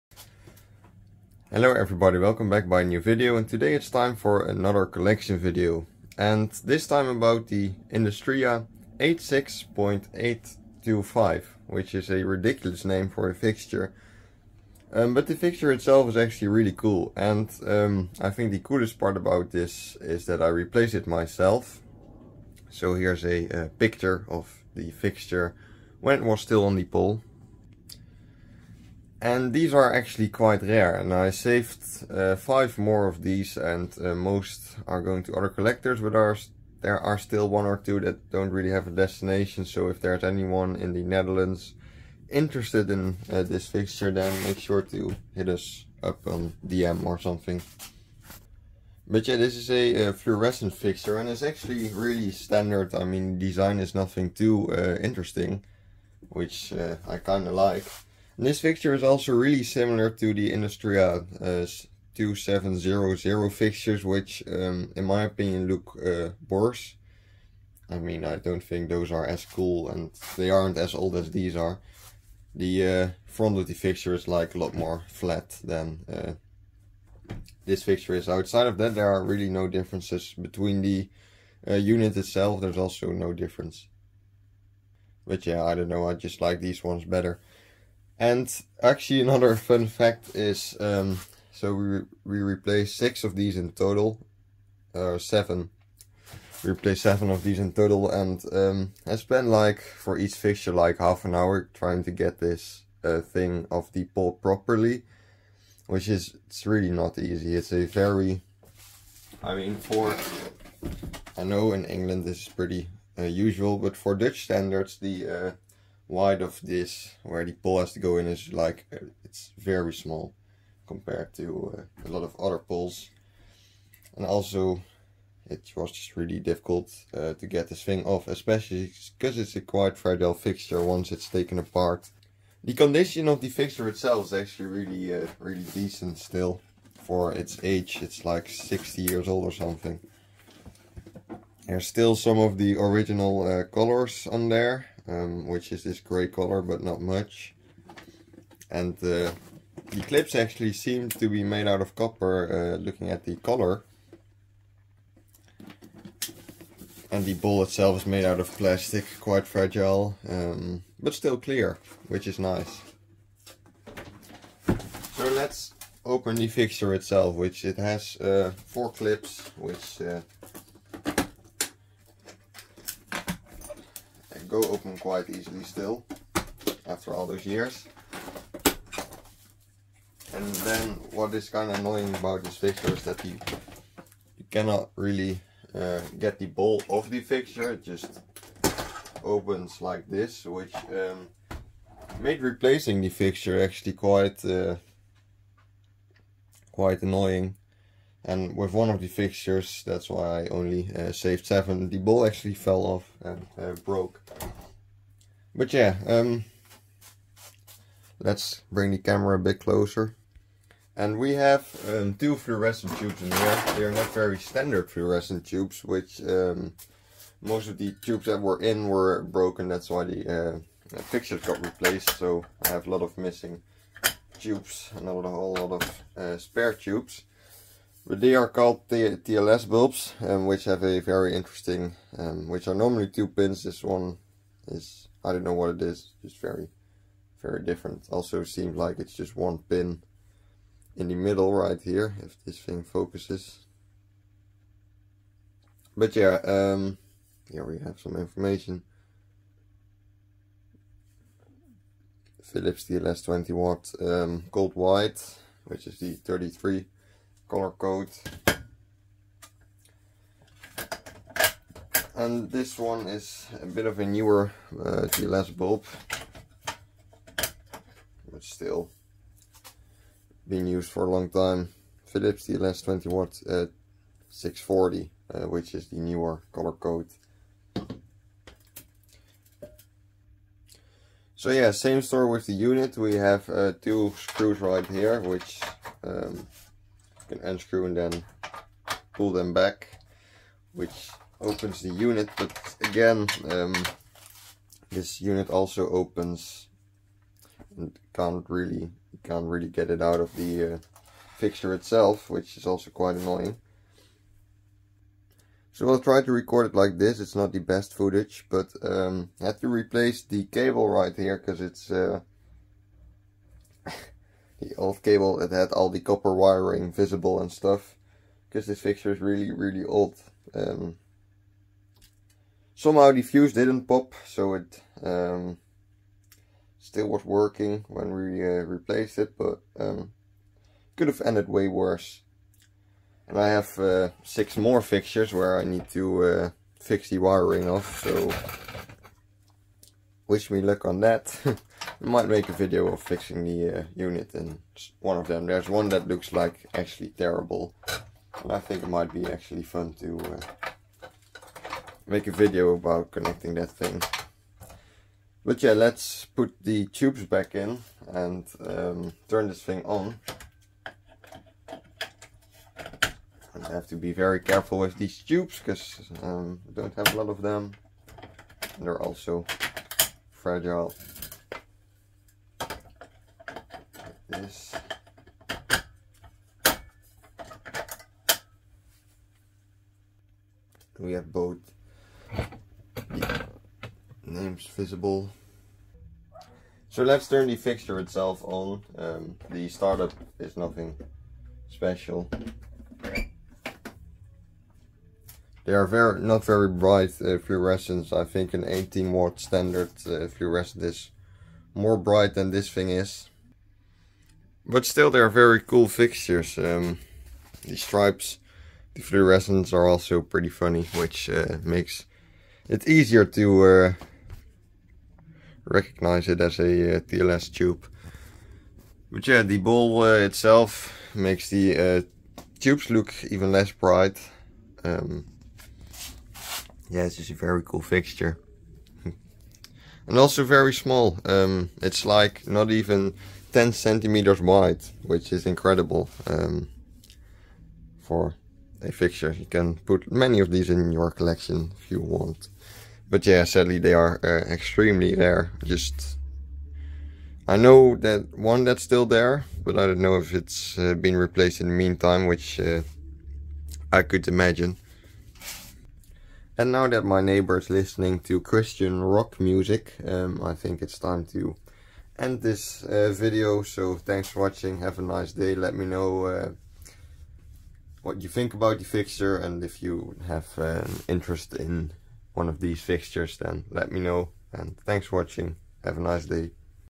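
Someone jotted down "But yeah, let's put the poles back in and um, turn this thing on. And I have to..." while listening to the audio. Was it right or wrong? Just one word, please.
wrong.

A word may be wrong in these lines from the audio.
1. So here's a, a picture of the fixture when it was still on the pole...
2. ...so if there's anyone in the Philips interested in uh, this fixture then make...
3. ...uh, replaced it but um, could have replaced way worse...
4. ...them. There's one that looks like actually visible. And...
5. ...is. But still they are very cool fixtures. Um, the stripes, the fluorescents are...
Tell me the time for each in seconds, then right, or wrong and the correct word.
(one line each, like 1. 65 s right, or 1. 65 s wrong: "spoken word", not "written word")
1. 22 s right
2. 39 s wrong: "Netherlands", not "Philips"
3. 328 s wrong: "ended", not "replaced"
4. 345 s wrong: "terrible", not "visible"
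5. 402 s right.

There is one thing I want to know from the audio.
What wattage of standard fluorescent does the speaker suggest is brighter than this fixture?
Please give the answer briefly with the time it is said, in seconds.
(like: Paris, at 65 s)
18 watt, at 398 s.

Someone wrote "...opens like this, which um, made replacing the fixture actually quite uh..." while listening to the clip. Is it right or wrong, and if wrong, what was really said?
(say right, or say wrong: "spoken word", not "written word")
right.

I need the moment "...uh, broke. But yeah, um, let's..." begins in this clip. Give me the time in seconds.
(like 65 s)
203 s.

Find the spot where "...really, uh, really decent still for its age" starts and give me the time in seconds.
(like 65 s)
134 s.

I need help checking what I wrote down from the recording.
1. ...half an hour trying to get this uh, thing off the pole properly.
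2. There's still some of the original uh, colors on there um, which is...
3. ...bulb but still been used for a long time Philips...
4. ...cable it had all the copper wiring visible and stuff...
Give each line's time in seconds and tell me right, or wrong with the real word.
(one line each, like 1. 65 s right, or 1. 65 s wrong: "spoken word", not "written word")
1. 100 s right
2. 141 s right
3. 265 s right
4. 315 s right.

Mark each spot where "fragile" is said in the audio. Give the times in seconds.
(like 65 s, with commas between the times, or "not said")
129 s, 159 s, 370 s.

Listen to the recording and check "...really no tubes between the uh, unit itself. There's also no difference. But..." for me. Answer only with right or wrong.
wrong.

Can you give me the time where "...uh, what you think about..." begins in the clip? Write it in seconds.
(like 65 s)
466 s.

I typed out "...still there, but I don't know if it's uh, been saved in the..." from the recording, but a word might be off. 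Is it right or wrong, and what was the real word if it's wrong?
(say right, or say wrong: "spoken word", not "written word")
wrong: "replaced", not "saved".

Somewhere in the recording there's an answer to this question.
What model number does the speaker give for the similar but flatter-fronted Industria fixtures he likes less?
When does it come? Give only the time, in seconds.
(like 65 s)
62 s.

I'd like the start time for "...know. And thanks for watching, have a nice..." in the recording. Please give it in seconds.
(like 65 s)
474 s.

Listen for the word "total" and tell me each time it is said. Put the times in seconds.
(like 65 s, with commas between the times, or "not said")
93 s, 97 s.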